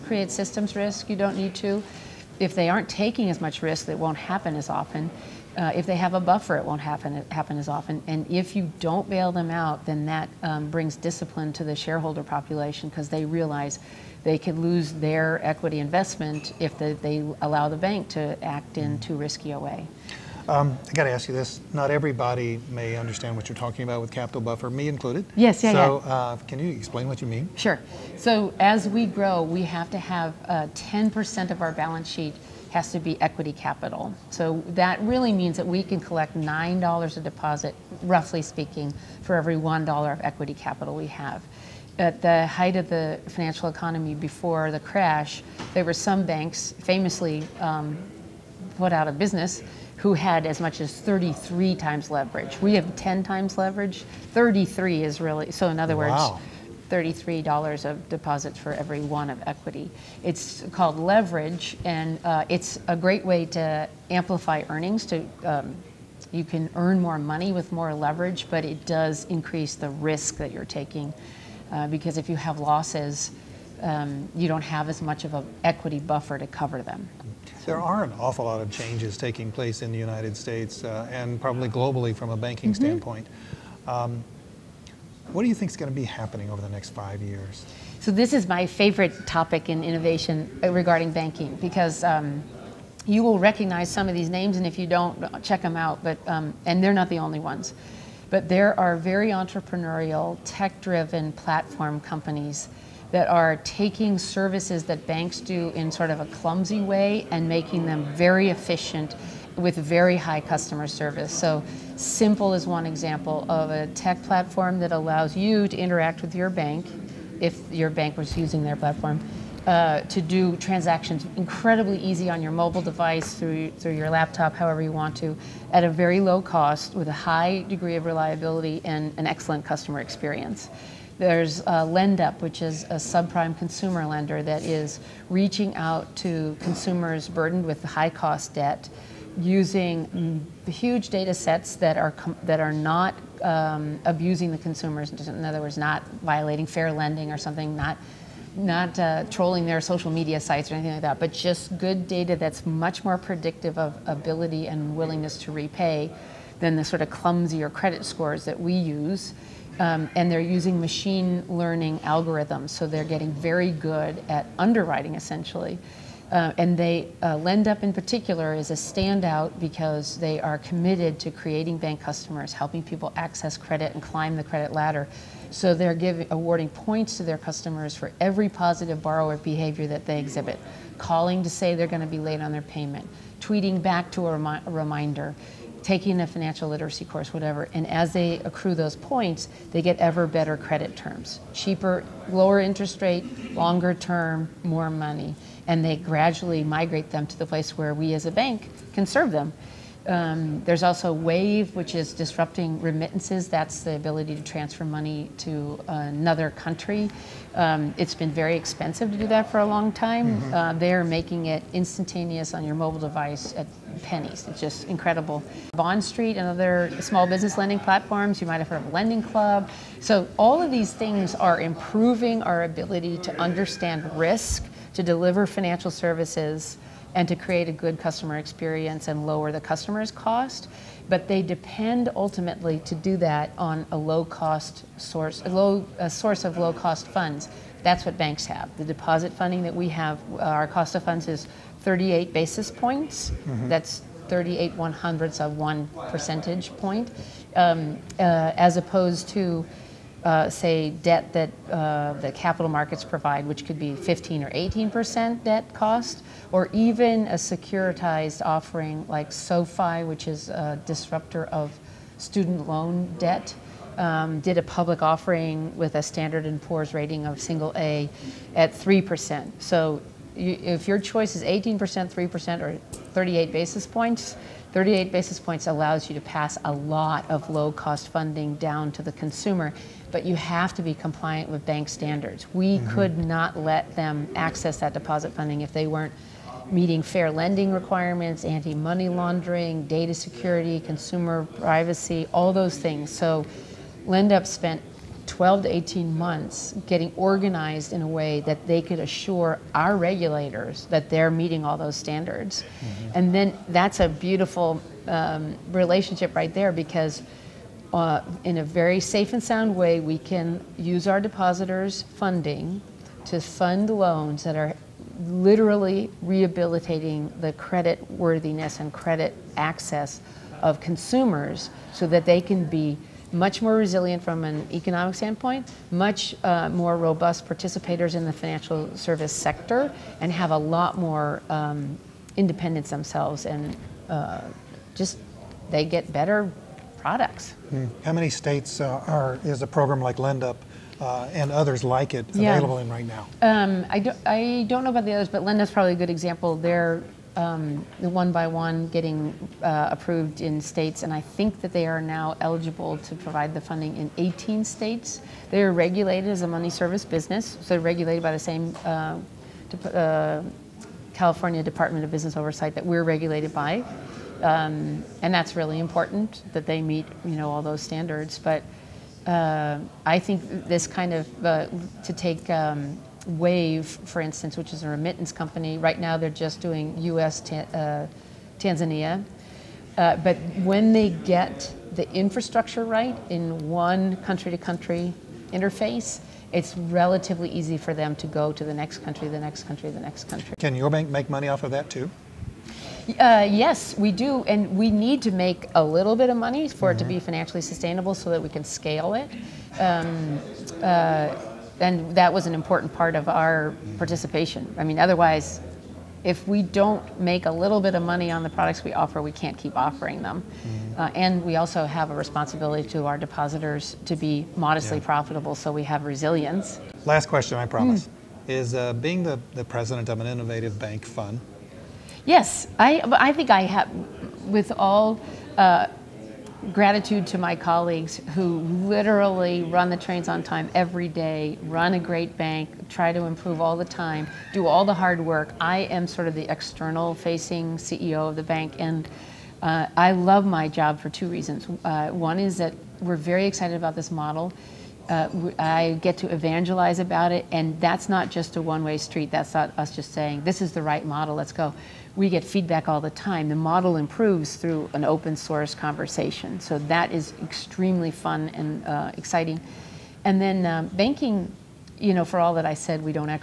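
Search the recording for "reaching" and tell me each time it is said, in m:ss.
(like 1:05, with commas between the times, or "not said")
2:15.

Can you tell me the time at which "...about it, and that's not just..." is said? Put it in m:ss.
7:26.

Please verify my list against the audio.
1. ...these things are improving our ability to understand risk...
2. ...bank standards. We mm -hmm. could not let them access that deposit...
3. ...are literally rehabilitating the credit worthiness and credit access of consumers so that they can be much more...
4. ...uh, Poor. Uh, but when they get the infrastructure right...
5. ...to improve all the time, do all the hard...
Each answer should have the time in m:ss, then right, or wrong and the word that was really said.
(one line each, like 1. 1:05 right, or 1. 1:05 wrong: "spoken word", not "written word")
1. 3:40 right
2. 4:41 right
3. 5:14 right
4. 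6:17 wrong: "Tanzania", not "Poor"
5. 7:13 right.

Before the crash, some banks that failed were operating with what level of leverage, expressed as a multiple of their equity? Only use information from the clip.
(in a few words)
33 times.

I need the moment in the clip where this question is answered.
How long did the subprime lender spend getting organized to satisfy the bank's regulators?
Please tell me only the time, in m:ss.
4:55.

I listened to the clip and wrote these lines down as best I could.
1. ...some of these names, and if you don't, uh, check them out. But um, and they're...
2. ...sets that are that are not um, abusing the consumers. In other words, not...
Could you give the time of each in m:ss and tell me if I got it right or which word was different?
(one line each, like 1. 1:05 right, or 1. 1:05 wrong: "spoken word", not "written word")
1. 1:33 right
2. 2:21 right.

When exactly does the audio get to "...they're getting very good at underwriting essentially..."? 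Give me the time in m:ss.
2:42.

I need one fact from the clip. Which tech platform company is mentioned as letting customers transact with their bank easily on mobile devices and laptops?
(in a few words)
Simple.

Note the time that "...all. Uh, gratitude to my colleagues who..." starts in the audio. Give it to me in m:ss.
7:04.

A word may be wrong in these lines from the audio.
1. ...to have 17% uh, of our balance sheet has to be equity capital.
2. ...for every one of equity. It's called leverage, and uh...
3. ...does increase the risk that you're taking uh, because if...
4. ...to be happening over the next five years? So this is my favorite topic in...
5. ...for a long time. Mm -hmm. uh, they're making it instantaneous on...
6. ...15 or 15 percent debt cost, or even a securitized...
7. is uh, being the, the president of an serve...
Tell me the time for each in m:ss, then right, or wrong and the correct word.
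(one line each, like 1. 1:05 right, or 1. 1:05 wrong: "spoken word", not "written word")
1. 0:29 wrong: "10", not "17"
2. 0:58 right
3. 1:08 right
4. 1:25 right
5. 3:29 right
6. 4:13 wrong: "18", not "15"
7. 6:58 wrong: "innovative", not "serve".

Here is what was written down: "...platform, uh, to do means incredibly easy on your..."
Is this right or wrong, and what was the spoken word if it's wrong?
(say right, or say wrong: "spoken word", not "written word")
wrong: "transactions", not "means".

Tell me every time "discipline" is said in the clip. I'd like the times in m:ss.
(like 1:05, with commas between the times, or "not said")
0:10.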